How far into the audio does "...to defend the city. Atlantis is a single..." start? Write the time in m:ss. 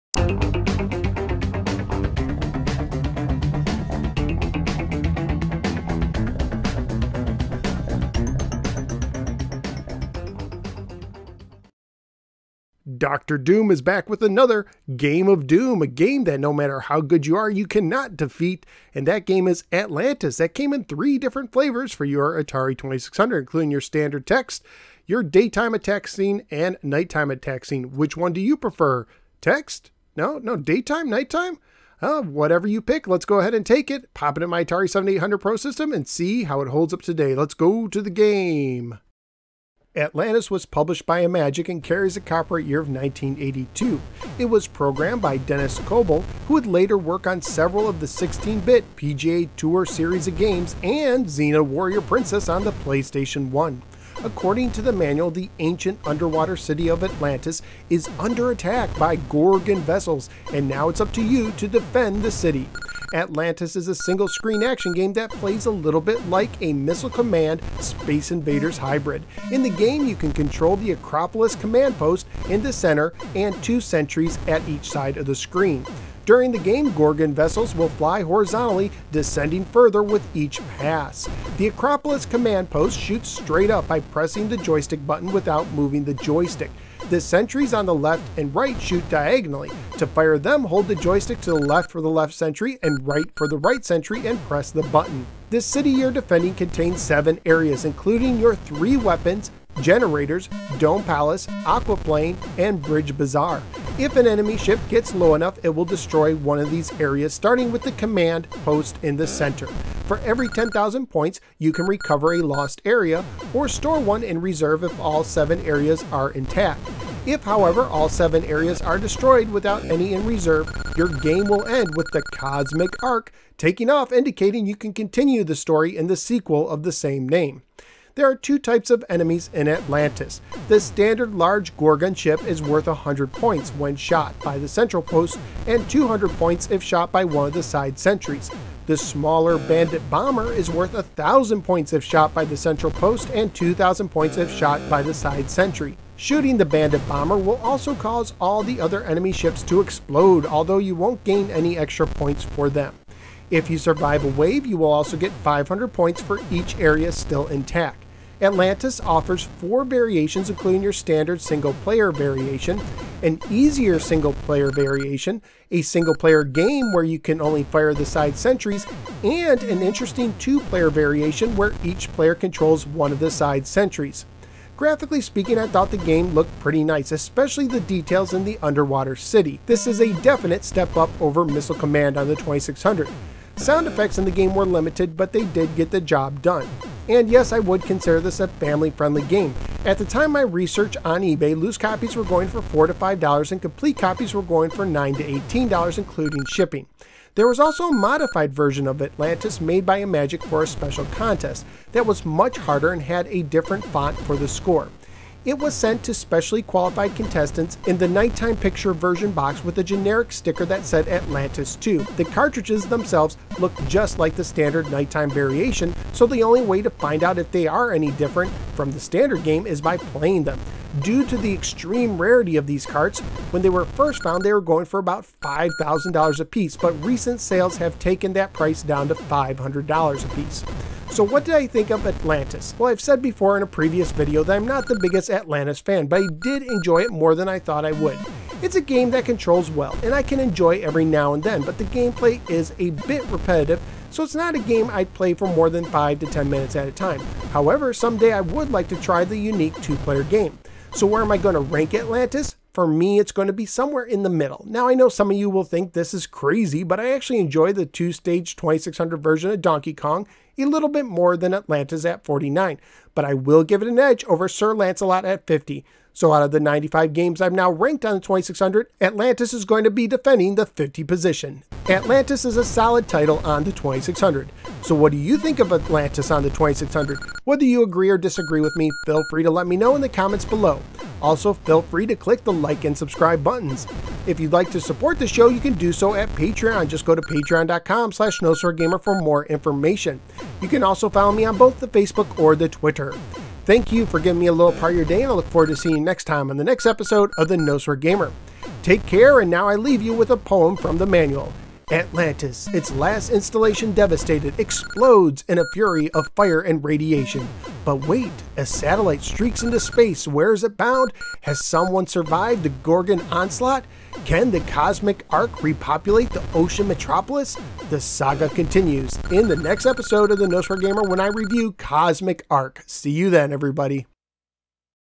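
1:01.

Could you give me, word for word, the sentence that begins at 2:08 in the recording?
There are two types of enemies in Atlantis.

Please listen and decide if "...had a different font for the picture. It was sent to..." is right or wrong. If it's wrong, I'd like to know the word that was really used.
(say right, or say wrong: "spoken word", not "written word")
wrong: "score", not "picture".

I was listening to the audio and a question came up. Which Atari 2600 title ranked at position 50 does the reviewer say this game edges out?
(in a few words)
Sir Lancelot.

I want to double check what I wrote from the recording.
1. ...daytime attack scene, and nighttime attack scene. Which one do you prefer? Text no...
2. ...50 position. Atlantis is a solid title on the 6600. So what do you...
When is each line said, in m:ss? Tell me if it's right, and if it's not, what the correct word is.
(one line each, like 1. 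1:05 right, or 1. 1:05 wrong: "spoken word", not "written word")
1. 0:25 right
2. 4:30 wrong: "2600", not "6600".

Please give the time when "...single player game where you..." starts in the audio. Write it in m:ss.
2:45.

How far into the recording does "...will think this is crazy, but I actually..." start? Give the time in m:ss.
4:15.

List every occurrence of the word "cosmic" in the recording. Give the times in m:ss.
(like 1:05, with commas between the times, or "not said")
2:02, 5:14, 5:21.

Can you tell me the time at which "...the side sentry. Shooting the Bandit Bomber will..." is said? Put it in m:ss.
2:25.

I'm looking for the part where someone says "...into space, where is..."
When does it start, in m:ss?
5:09.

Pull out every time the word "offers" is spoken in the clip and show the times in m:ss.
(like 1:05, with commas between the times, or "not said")
2:39.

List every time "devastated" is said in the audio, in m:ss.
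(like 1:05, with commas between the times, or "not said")
5:03.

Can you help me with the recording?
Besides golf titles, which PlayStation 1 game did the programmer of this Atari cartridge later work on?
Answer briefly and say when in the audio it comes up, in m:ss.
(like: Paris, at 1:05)
Xena Warrior Princess, at 0:51.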